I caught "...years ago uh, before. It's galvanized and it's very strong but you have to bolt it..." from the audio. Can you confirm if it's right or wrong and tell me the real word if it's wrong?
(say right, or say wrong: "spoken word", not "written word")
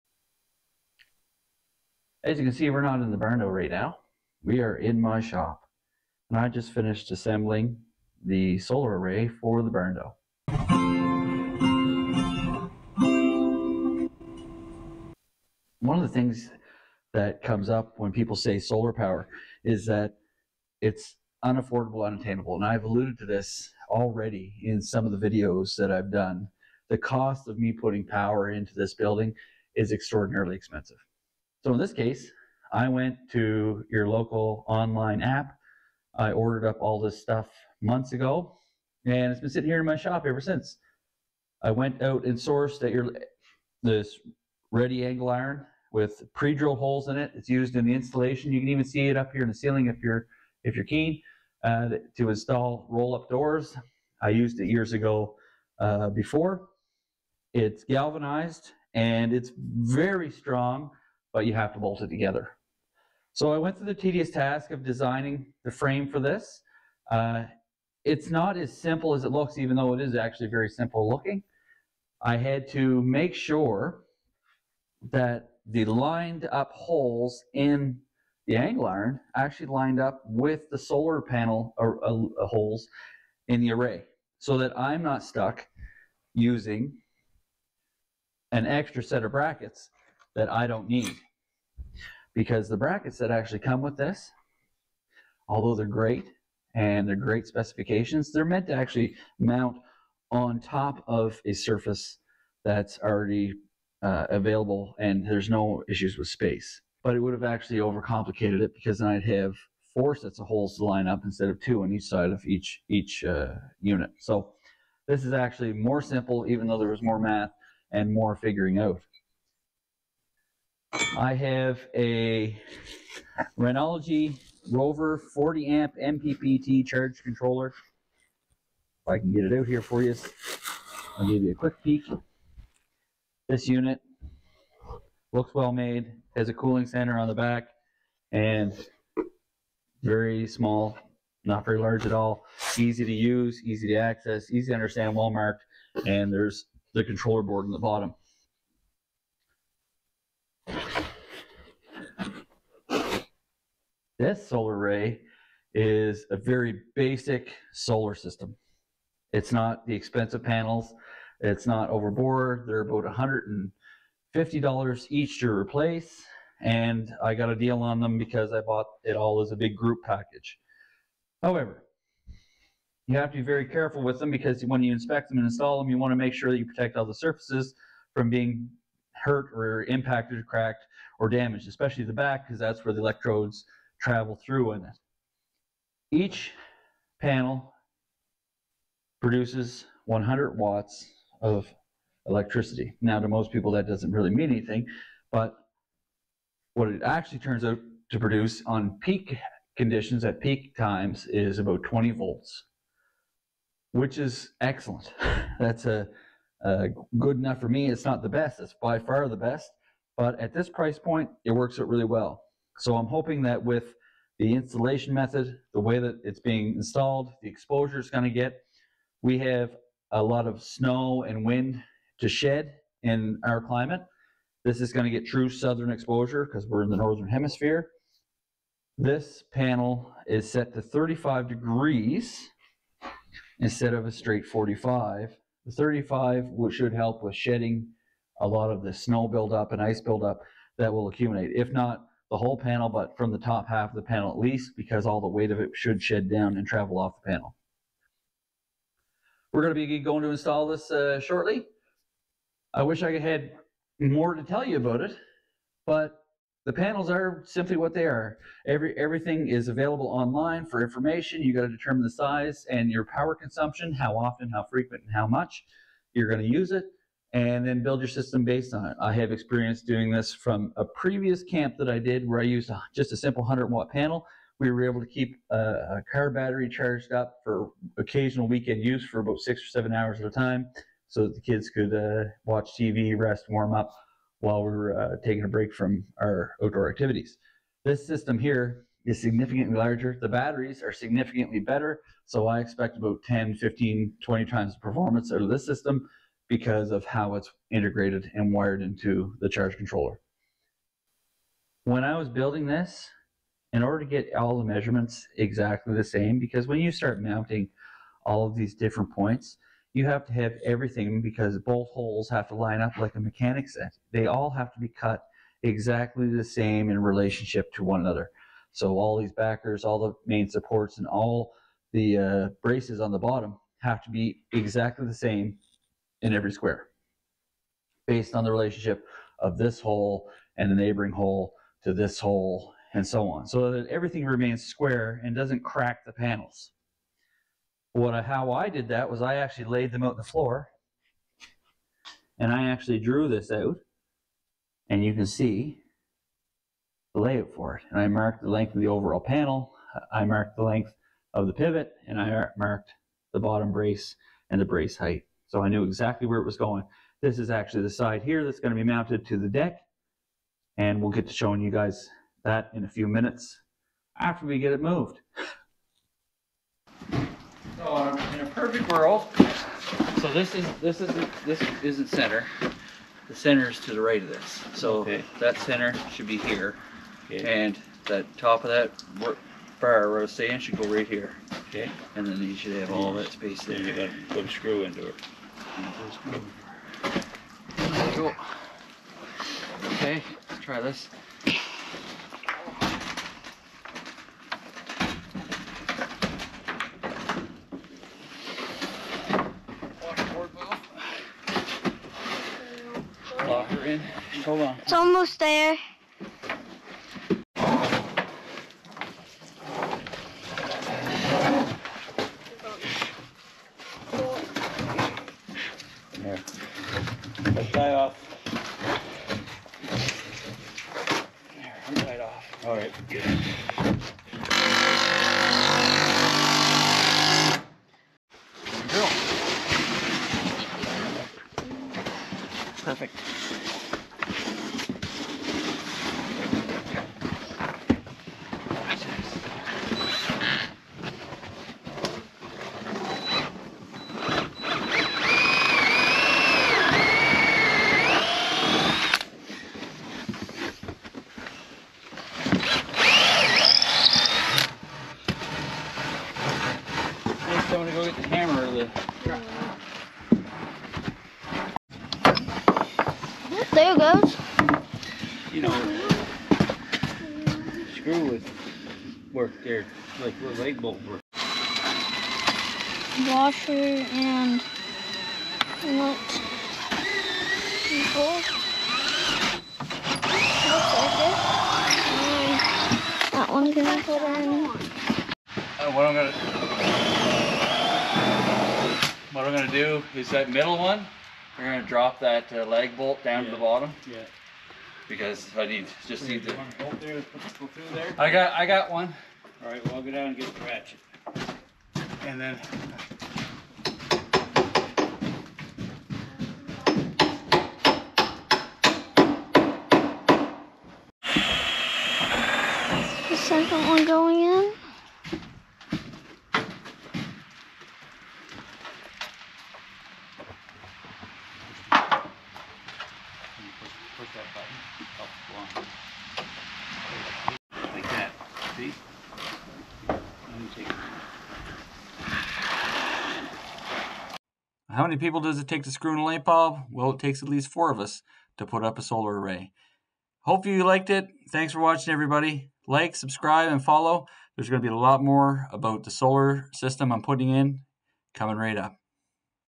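right.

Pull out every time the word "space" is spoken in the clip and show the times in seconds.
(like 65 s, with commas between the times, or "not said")
106 s, 383 s.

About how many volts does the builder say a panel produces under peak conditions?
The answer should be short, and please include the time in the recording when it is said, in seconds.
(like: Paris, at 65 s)
20 volts, at 201 s.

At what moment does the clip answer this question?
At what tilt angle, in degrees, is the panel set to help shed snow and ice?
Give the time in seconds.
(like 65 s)
230 s.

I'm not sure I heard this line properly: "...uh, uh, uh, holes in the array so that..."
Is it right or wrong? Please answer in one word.
right.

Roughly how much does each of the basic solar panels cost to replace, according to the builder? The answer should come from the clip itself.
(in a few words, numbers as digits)
$150.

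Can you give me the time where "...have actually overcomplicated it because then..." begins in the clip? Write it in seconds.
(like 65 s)
107 s.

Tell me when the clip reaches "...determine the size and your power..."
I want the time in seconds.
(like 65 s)
261 s.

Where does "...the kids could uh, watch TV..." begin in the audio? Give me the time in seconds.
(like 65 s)
281 s.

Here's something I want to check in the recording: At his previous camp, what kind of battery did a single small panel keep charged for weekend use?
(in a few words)
car battery.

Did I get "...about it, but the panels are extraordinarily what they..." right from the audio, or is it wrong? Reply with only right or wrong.
wrong.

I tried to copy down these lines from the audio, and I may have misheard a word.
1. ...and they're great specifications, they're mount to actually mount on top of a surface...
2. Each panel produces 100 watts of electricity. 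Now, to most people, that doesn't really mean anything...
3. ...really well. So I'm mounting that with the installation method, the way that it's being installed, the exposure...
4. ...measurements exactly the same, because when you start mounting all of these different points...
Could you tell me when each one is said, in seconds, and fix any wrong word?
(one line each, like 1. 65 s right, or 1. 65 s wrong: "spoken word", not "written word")
1. 96 s wrong: "meant", not "mount"
2. 186 s right
3. 211 s wrong: "hoping", not "mounting"
4. 304 s right.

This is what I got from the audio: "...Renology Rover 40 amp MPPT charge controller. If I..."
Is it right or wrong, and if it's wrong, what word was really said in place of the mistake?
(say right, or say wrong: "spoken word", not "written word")
right.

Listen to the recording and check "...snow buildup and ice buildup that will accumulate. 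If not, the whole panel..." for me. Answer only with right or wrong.
right.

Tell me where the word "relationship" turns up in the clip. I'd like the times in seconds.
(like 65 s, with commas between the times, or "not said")
317 s, 328 s.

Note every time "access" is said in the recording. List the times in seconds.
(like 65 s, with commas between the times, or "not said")
143 s.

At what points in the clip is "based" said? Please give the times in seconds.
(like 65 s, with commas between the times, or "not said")
268 s, 328 s.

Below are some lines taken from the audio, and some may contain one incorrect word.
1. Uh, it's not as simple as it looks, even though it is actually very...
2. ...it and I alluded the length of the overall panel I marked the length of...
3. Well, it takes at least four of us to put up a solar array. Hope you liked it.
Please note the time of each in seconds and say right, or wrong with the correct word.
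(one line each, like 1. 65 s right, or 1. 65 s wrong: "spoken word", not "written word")
1. 67 s right
2. 347 s wrong: "marked", not "alluded"
3. 536 s right.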